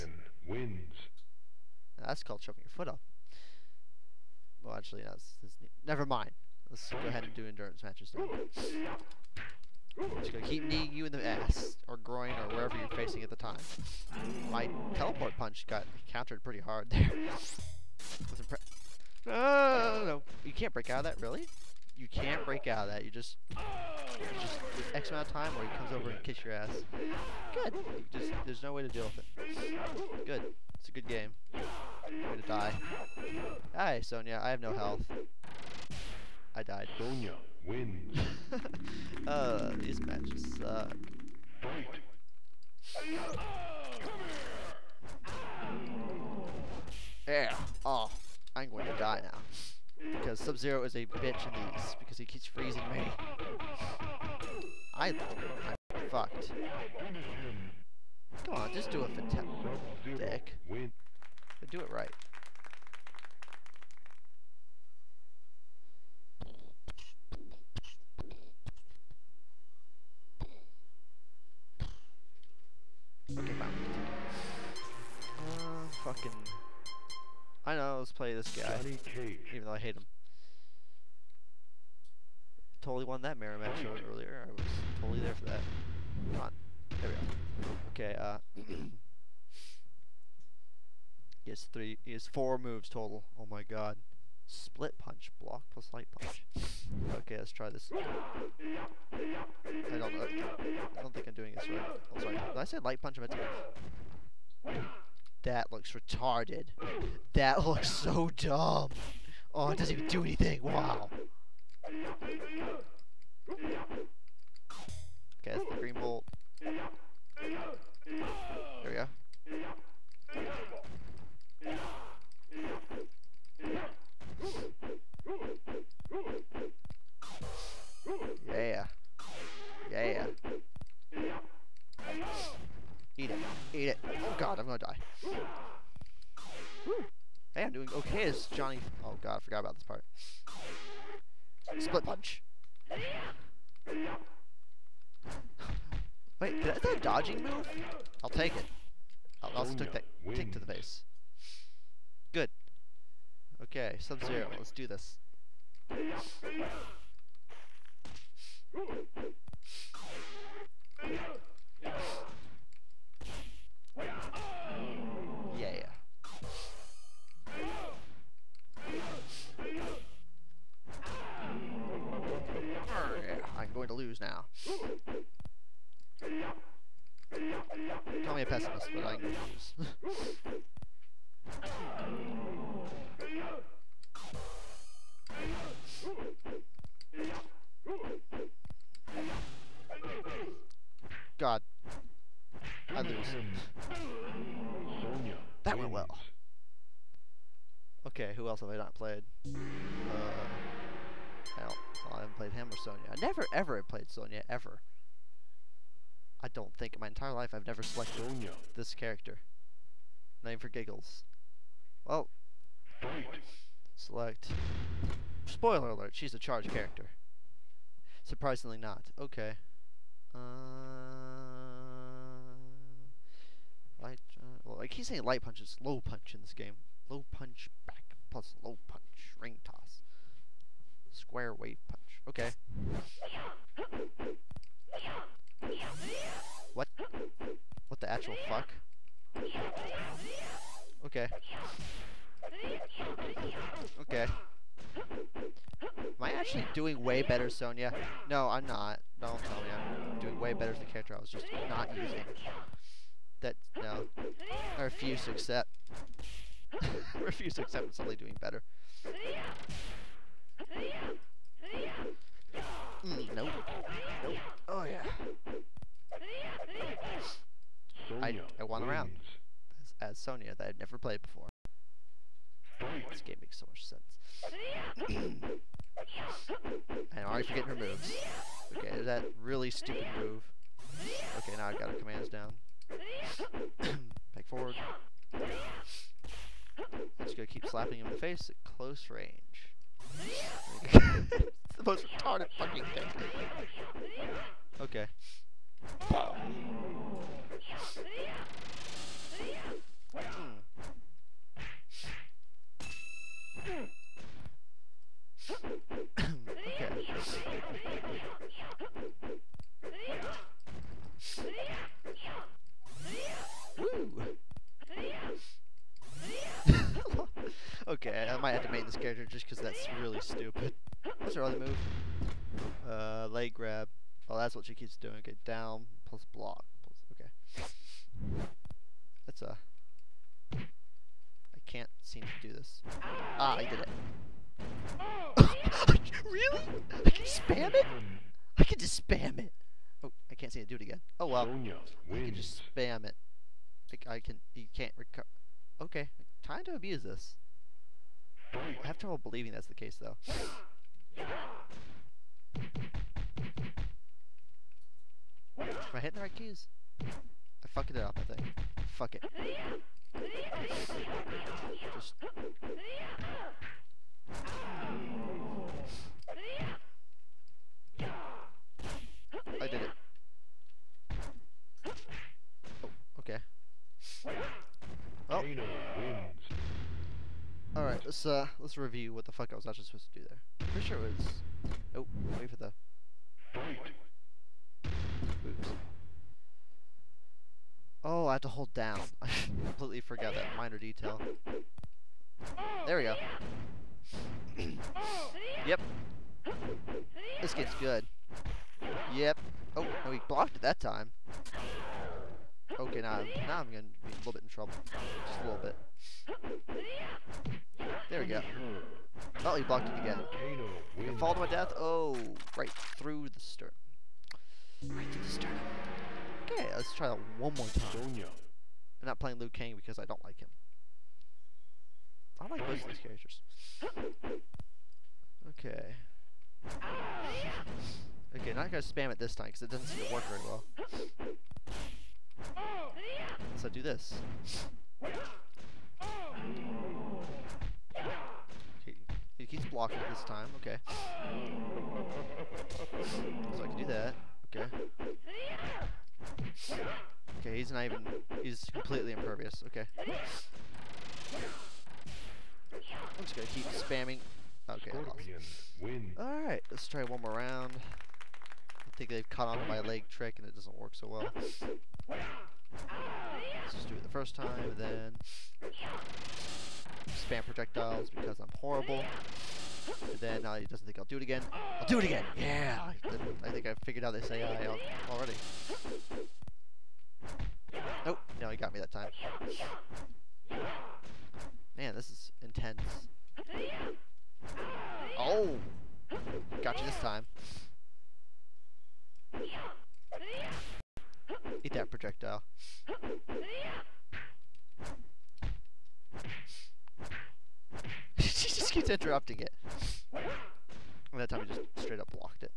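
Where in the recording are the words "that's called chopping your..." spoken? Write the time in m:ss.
0:02.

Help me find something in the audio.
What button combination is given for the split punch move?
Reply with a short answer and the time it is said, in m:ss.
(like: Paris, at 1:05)
block plus light punch, at 1:35.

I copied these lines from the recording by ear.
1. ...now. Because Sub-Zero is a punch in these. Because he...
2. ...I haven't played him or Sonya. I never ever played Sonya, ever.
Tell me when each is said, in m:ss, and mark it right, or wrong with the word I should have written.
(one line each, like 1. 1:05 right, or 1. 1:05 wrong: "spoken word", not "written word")
1. 0:49 wrong: "bitch", not "punch"
2. 3:22 right.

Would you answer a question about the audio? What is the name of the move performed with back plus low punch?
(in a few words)
Ring toss.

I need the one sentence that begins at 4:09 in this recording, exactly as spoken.
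Don't tell me I'm doing way better as the character I was just not using that no, I refuse to accept.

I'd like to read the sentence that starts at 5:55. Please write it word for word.
Am I hitting the right keys?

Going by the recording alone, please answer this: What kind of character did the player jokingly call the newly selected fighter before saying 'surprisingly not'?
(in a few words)
charge character.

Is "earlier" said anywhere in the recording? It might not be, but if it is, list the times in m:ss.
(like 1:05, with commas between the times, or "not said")
1:24.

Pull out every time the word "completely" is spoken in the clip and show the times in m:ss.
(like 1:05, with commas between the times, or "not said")
6:29, 7:28.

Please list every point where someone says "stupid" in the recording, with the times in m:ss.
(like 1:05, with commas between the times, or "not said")
4:39, 5:20.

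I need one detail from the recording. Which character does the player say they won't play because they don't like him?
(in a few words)
Liu Kang.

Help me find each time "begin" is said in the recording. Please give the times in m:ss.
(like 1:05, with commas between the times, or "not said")
not said.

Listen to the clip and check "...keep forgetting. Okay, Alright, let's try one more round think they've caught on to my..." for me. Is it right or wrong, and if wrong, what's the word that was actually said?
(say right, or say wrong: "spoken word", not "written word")
wrong: "spamming", not "forgetting".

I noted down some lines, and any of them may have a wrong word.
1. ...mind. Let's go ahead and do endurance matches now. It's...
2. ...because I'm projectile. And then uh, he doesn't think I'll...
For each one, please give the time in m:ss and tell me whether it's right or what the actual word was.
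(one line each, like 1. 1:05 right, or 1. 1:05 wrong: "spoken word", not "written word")
1. 0:06 right
2. 7:48 wrong: "horrible", not "projectile".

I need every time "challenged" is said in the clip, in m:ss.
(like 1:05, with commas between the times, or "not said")
not said.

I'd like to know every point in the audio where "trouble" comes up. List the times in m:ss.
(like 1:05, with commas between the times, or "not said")
5:48, 6:44.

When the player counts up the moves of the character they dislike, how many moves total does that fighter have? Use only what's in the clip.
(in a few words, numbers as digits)
4.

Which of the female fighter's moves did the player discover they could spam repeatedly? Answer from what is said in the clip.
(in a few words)
leg grab.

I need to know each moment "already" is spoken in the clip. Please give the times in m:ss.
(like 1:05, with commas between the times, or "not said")
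4:37, 7:55.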